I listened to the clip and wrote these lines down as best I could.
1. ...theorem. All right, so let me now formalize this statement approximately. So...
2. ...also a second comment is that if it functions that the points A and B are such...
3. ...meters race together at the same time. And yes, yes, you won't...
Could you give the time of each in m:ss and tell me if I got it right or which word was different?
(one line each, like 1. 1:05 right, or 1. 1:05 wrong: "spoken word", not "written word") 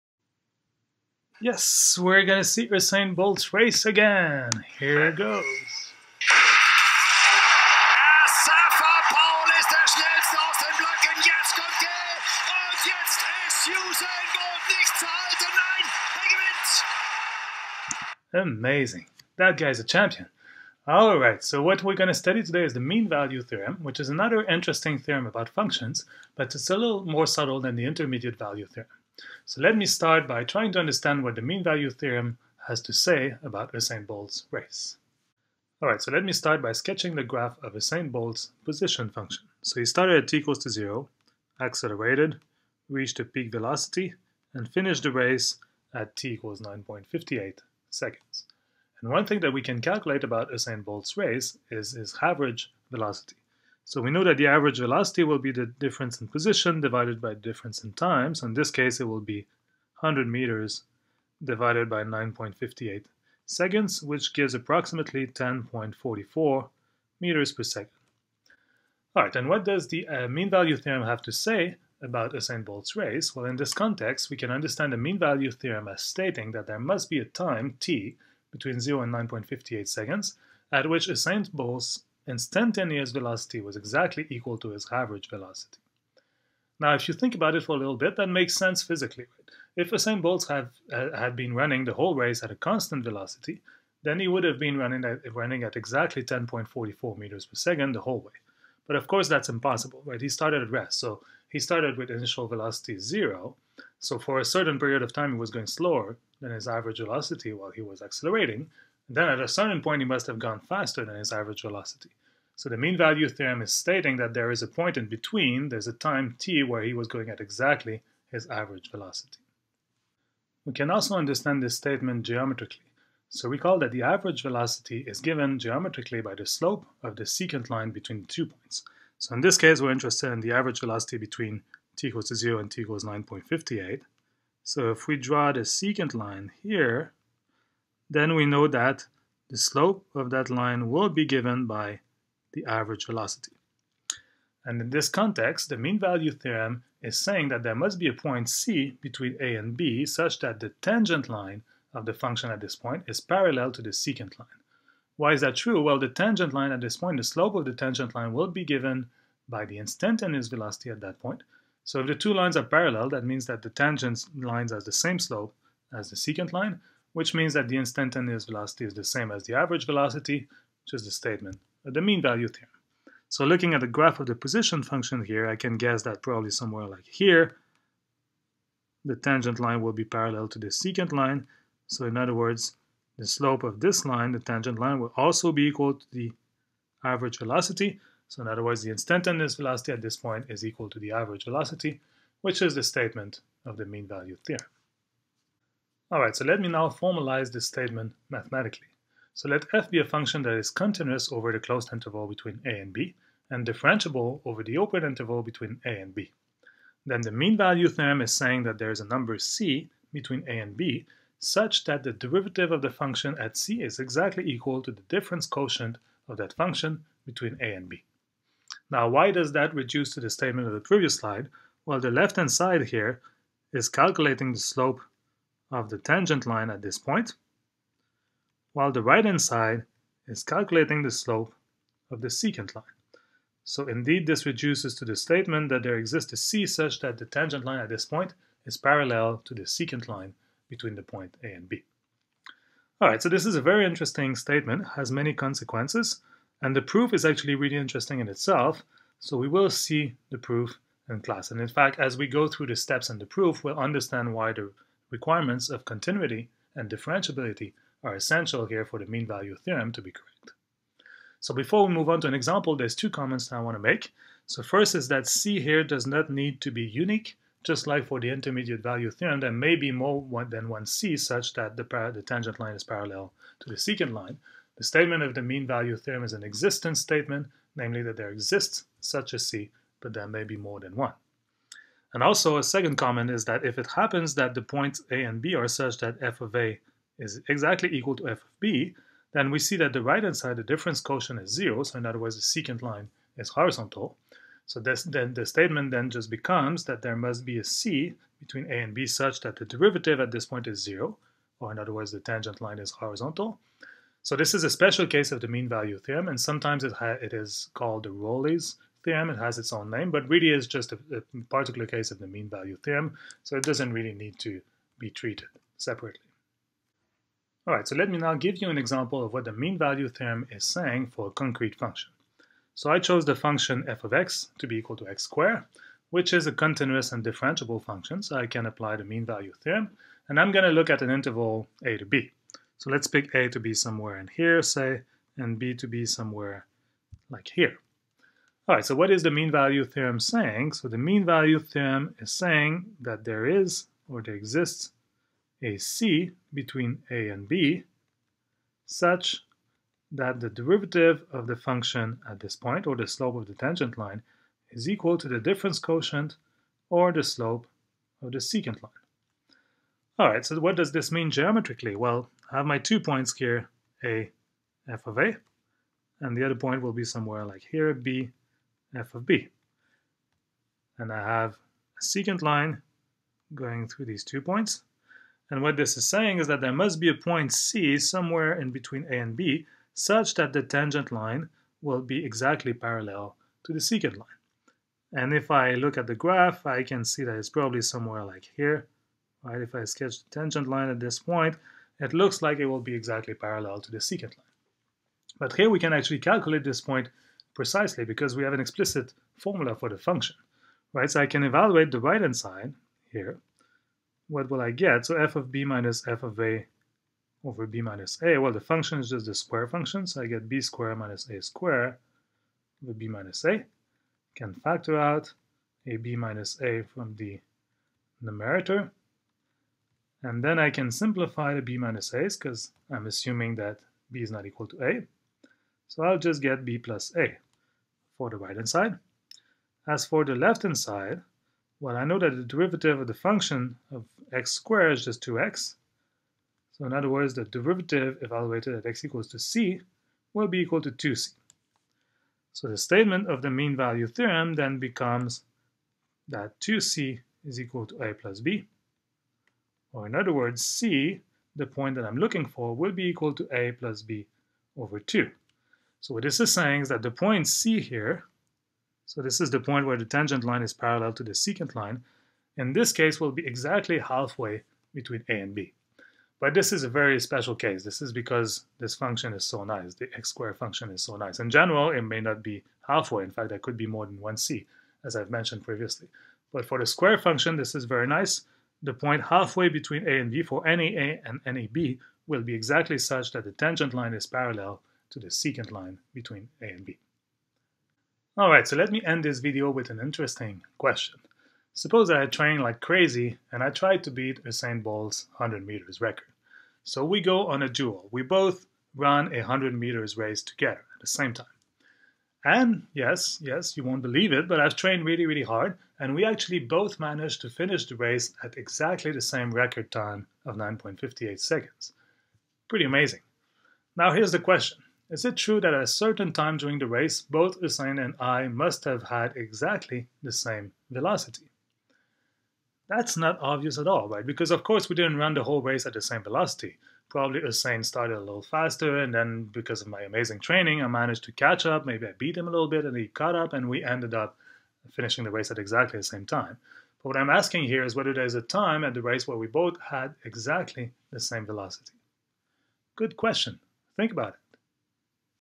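1. 3:14 wrong: "mathematically", not "approximately"
2. 4:42 wrong: "happens", not "functions"
3. 8:19 right.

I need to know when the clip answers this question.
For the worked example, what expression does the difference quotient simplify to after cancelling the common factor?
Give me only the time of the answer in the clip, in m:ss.
7:06.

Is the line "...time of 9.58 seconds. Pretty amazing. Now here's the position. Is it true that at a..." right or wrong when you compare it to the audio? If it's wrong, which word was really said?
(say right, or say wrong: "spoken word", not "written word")
wrong: "question", not "position".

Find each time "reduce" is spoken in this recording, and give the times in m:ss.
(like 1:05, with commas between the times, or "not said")
3:39, 3:54.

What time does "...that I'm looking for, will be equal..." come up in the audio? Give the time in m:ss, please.
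7:31.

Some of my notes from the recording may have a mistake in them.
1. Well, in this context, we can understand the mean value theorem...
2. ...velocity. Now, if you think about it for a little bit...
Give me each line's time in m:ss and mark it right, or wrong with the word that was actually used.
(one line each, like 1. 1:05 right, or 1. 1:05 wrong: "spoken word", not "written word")
1. 1:13 right
2. 1:25 right.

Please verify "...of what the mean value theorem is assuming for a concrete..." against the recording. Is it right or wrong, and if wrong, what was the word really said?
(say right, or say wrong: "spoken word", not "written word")
wrong: "saying", not "assuming".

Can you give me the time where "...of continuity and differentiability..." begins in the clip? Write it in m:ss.
4:15.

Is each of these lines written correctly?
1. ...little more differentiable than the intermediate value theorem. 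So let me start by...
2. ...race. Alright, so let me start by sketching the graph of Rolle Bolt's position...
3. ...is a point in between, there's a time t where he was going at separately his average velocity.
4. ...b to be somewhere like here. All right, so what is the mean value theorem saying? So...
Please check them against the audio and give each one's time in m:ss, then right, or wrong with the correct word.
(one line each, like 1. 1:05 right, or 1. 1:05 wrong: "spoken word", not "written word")
1. 0:26 wrong: "subtle", not "differentiable"
2. 0:34 wrong: "Usain", not "Rolle"
3. 1:54 wrong: "exactly", not "separately"
4. 5:35 right.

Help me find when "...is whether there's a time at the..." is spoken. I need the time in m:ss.
8:57.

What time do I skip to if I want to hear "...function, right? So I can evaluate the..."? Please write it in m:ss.
6:39.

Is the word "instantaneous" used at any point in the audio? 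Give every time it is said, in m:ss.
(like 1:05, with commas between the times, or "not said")
1:22, 2:39, 2:47, 3:08.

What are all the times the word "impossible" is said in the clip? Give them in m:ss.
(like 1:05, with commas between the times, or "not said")
1:39.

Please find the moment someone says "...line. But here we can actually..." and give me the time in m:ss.
6:34.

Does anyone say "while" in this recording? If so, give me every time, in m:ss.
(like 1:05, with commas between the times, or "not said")
1:47, 3:48.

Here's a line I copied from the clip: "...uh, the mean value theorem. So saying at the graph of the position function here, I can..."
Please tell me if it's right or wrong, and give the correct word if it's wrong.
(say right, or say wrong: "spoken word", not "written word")
wrong: "looking", not "saying".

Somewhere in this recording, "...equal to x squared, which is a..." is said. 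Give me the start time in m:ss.
5:24.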